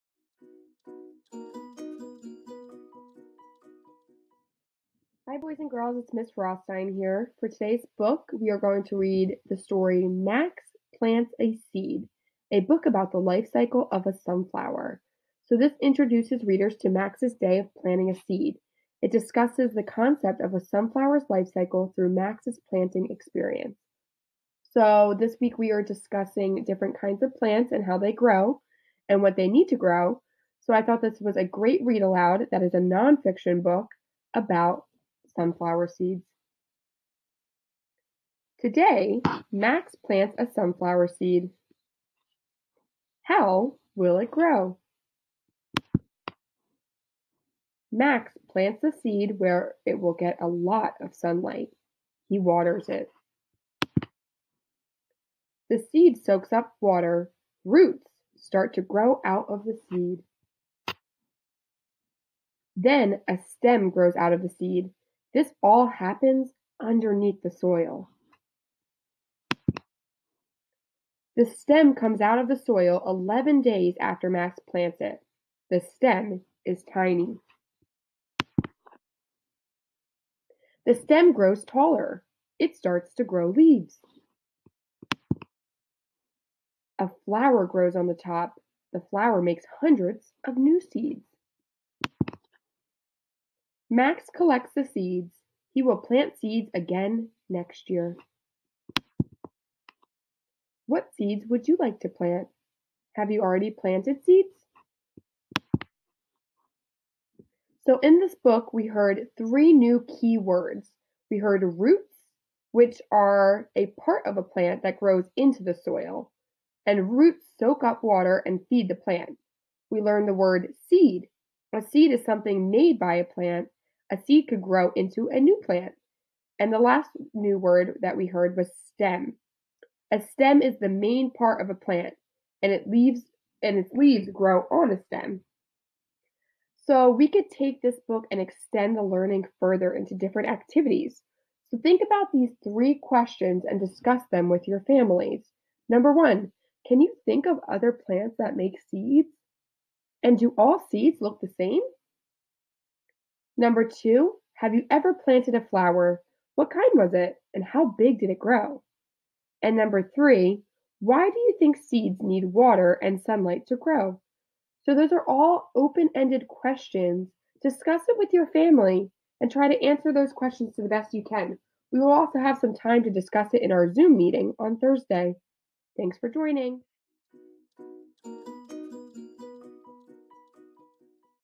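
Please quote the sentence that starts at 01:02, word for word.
Then a stem grows out of the seed.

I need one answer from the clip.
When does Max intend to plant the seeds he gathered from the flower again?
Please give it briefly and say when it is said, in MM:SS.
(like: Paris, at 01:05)
Next year, at 01:37.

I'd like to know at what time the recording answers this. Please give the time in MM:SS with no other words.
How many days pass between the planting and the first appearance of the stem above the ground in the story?
01:13.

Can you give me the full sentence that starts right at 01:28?
The flower makes hundreds of new seeds.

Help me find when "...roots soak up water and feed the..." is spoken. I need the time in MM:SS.
01:57.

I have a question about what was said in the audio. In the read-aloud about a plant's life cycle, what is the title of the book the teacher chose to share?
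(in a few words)
Max Plants a Seed.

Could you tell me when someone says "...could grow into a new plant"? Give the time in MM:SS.
02:04.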